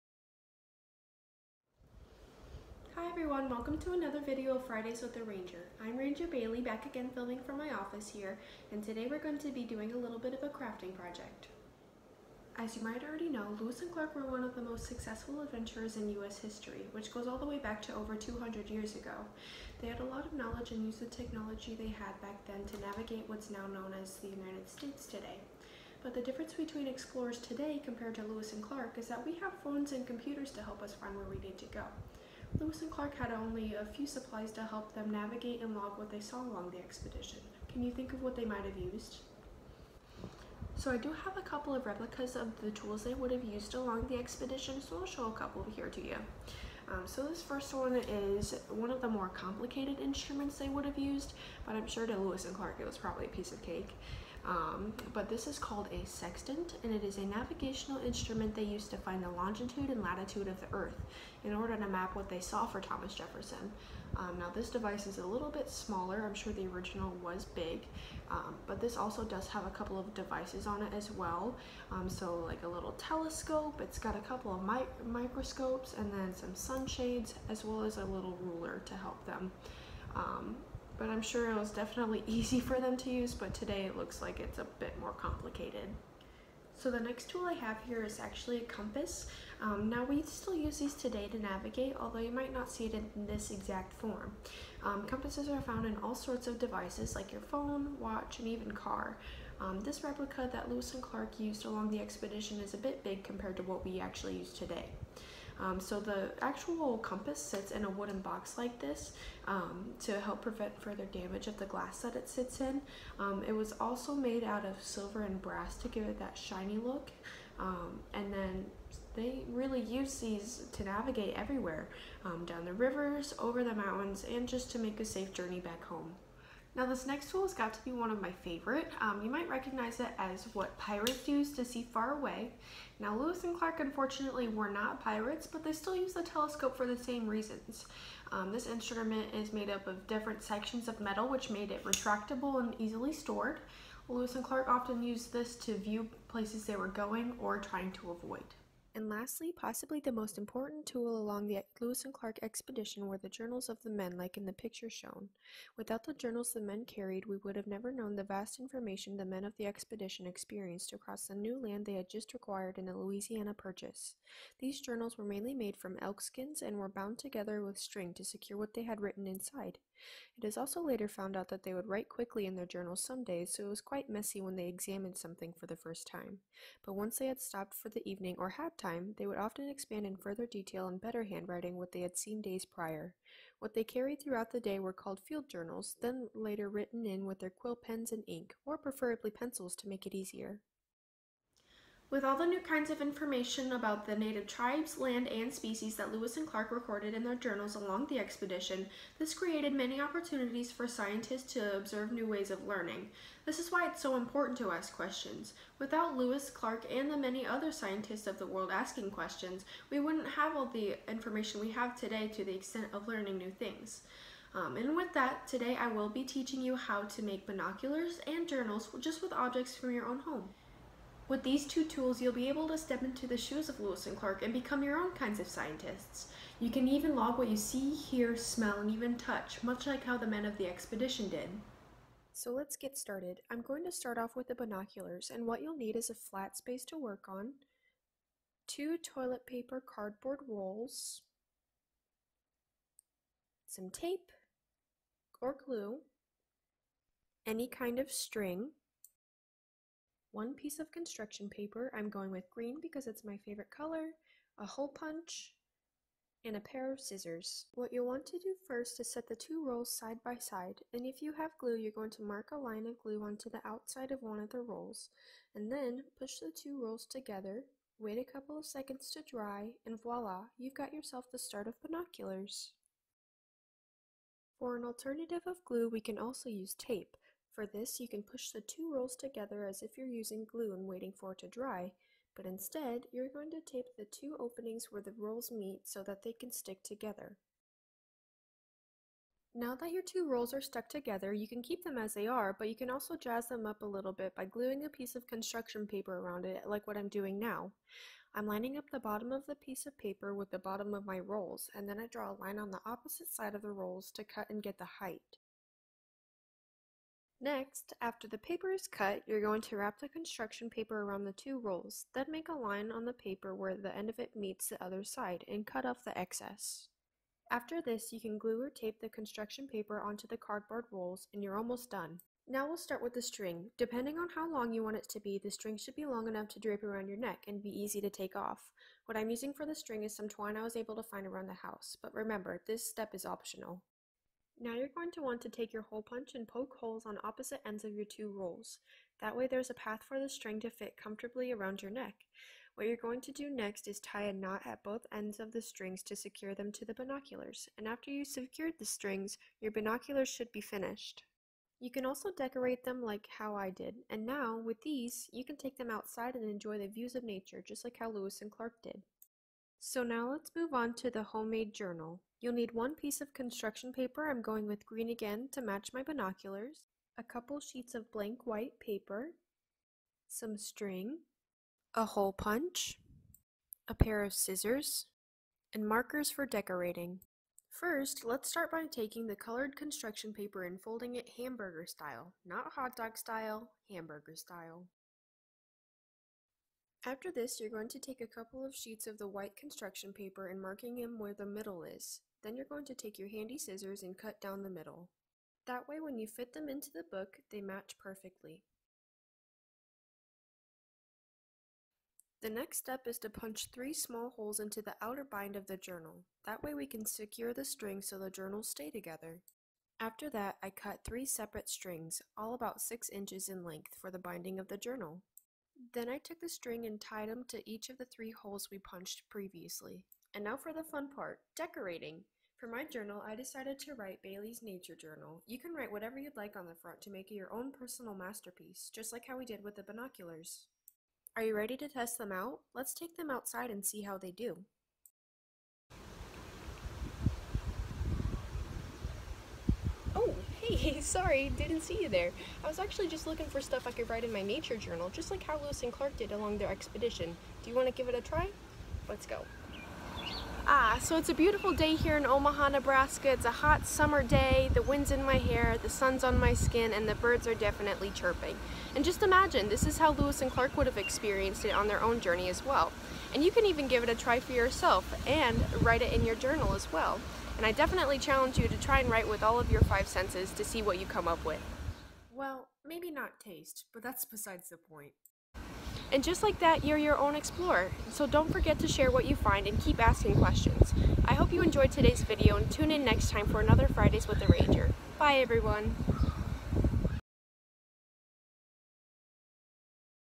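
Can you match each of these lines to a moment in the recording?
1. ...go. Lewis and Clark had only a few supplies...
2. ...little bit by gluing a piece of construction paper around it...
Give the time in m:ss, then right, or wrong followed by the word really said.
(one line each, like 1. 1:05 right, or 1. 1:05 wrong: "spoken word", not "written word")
1. 0:31 right
2. 4:53 right.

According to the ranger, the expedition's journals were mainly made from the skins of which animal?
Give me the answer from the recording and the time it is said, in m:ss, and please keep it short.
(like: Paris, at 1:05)
elk, at 2:46.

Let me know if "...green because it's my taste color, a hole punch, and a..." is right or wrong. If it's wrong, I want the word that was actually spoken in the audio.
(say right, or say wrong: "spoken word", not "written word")
wrong: "favorite", not "taste".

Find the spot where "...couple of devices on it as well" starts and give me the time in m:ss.
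1:09.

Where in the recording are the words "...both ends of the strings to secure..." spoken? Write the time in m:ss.
5:44.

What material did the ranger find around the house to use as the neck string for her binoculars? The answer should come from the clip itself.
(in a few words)
twine.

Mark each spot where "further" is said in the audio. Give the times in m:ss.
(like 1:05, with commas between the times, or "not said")
1:50, 3:00.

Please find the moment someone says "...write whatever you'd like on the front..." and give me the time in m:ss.
7:05.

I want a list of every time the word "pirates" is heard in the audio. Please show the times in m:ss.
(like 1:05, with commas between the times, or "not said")
2:10, 2:15.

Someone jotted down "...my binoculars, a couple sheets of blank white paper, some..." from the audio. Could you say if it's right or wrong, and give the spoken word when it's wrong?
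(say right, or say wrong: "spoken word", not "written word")
right.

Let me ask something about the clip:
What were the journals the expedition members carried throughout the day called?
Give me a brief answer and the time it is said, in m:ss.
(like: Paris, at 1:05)
field journals, at 3:05.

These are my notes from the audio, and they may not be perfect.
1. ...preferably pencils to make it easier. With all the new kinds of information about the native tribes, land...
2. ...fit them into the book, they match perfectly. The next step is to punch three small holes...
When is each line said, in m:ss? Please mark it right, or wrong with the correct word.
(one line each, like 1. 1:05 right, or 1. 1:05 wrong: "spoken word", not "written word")
1. 3:08 right
2. 6:36 right.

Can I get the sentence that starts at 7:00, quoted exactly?
And now for the fun part, decorating.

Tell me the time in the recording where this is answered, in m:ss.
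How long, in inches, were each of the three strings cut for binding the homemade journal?
6:52.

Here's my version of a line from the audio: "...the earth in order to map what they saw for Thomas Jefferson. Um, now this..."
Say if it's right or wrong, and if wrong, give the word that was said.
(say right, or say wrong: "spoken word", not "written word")
right.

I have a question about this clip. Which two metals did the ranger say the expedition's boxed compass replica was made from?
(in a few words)
silver and brass.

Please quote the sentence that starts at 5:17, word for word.
After this, you can glue or tape the construction paper onto the cardboard rolls and you're almost done.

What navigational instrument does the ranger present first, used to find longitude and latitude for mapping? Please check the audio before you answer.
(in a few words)
sextant.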